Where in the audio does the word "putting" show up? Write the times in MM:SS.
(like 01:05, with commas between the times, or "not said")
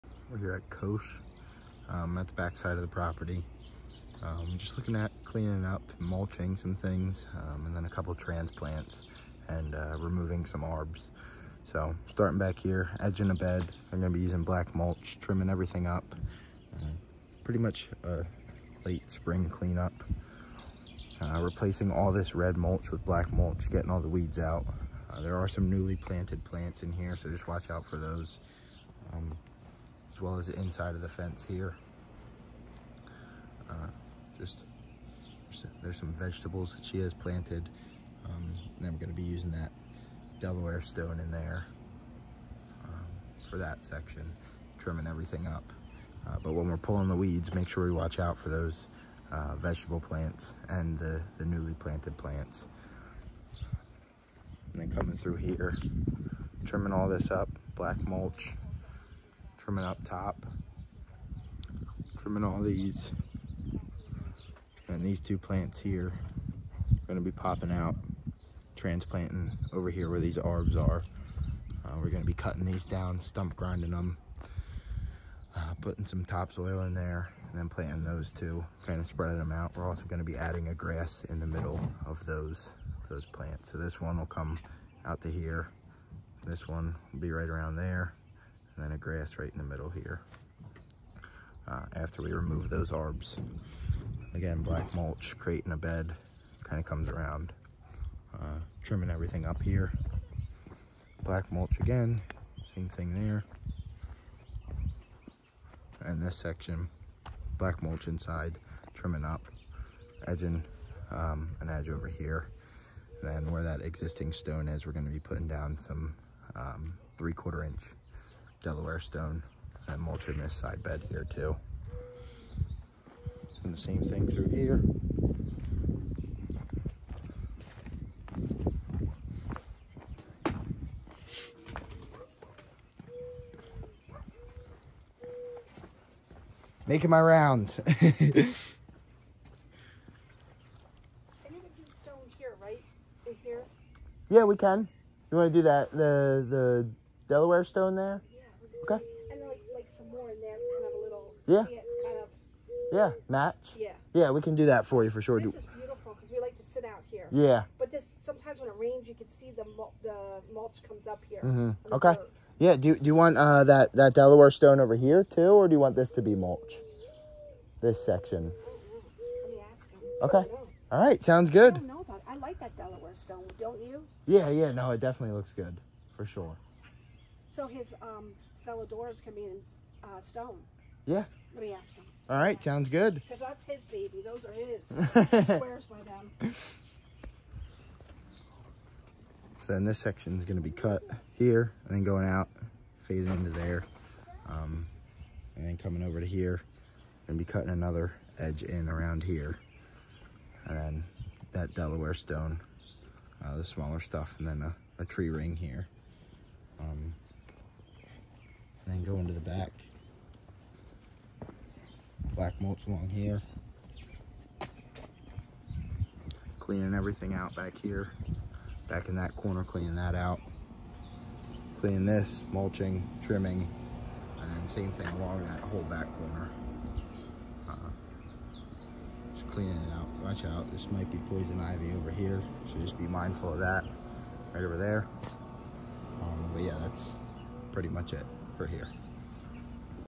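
01:15, 01:55.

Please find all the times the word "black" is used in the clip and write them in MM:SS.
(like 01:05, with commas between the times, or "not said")
00:14, 00:23, 00:57, 01:34, 01:41, 01:47, 03:32.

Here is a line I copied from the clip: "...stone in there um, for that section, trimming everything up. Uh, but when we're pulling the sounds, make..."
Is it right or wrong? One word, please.
wrong.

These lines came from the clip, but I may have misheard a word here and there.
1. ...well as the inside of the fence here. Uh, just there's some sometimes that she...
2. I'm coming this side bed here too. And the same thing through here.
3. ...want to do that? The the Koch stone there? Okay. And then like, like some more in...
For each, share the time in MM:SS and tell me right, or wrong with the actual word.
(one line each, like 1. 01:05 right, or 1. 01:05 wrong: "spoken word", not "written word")
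1. 00:30 wrong: "vegetables", not "sometimes"
2. 01:59 wrong: "mulching", not "coming"
3. 02:25 wrong: "Delaware", not "Koch".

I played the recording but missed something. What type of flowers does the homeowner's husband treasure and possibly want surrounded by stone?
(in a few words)
Stella d'Oros.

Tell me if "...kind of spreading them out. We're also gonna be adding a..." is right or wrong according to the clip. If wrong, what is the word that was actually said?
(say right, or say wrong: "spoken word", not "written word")
right.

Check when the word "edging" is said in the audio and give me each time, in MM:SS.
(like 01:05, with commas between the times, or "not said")
00:13, 01:50.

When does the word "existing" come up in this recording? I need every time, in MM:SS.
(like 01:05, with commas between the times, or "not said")
01:53.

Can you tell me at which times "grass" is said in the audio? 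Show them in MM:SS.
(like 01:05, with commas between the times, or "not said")
01:20, 01:28.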